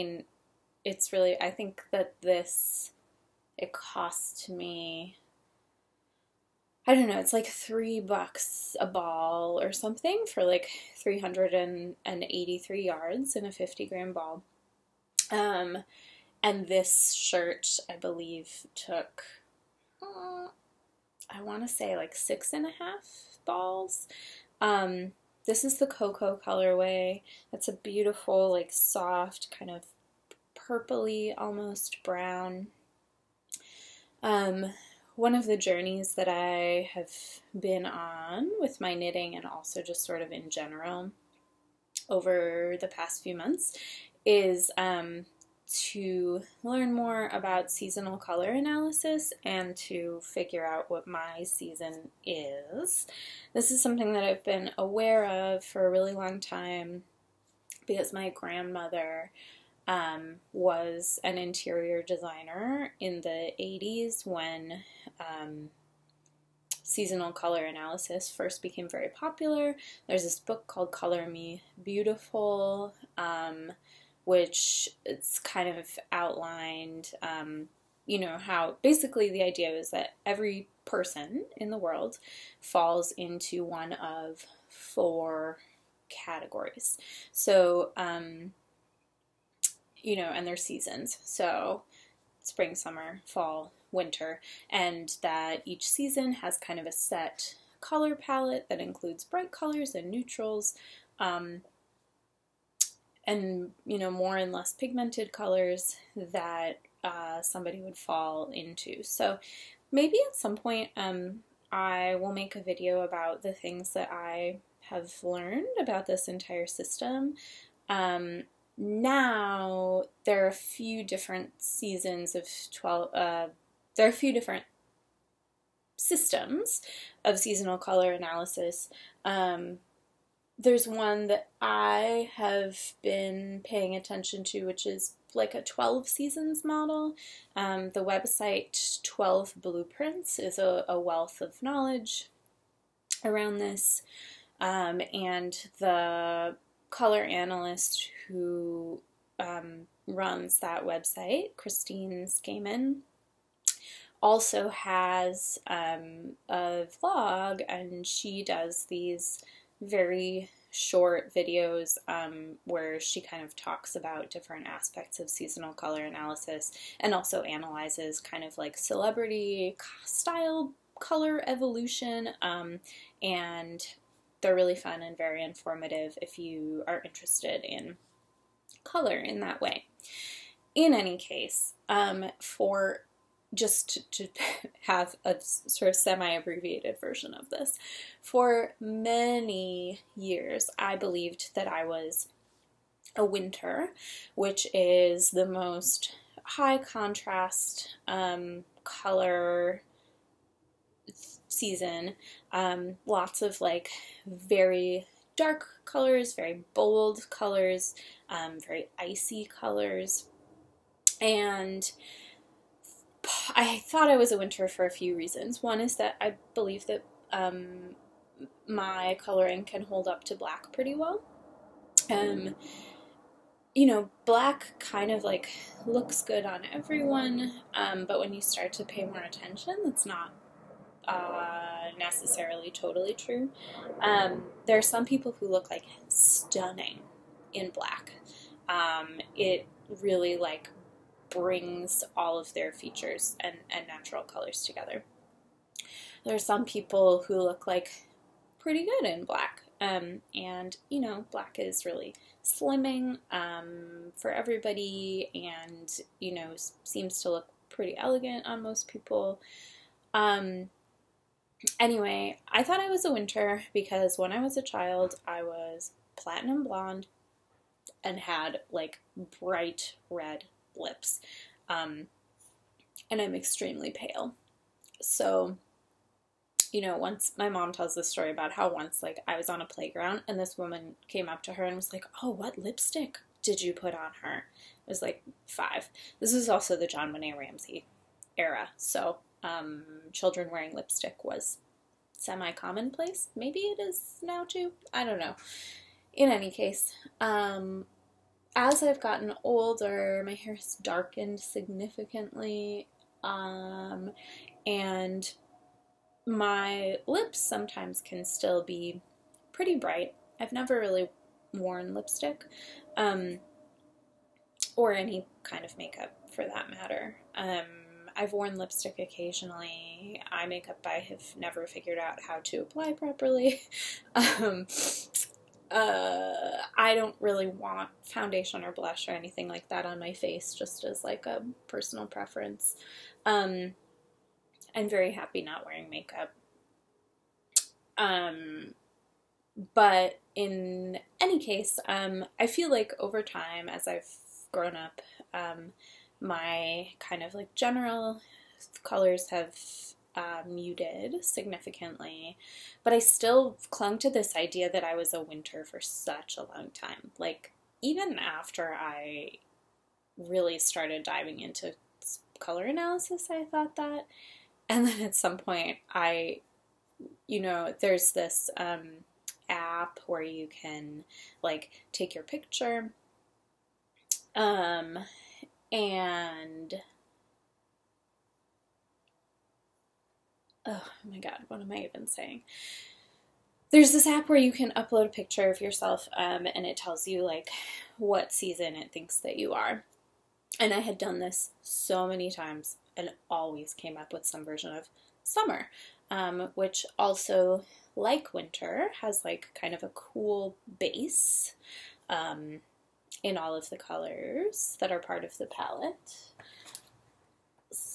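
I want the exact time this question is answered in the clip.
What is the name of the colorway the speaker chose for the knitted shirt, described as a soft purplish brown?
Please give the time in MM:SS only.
00:25.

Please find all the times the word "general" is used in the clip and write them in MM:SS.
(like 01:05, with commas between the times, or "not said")
00:40, 05:47.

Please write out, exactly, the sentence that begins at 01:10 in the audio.
There's this book called Color Me Beautiful.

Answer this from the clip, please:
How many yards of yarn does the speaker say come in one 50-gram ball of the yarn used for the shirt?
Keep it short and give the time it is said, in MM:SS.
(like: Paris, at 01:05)
383, at 00:10.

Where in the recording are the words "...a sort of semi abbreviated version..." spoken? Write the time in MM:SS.
03:05.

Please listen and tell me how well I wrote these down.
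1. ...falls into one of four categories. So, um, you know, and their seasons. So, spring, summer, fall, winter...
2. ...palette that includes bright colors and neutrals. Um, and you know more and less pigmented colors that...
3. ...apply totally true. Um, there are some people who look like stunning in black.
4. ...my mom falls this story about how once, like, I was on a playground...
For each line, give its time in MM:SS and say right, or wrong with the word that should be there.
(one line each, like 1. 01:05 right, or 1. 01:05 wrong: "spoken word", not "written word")
1. 01:22 right
2. 01:38 right
3. 03:51 wrong: "necessarily", not "apply"
4. 04:37 wrong: "tells", not "falls".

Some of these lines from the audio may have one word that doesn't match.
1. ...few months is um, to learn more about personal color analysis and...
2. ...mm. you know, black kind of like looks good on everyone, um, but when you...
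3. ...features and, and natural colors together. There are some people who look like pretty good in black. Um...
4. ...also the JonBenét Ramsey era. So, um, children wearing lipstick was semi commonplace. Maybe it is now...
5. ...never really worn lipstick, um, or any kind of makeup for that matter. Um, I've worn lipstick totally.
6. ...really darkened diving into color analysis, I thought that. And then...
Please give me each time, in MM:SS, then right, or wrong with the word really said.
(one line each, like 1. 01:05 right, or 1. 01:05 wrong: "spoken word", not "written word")
1. 00:43 wrong: "seasonal", not "personal"
2. 03:42 right
3. 04:02 right
4. 04:46 right
5. 05:10 wrong: "occasionally", not "totally"
6. 06:00 wrong: "started", not "darkened".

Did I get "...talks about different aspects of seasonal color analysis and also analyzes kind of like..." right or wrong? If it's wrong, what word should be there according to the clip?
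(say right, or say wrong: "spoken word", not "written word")
right.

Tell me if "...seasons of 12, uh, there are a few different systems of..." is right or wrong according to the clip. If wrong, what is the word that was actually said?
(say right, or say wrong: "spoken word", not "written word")
right.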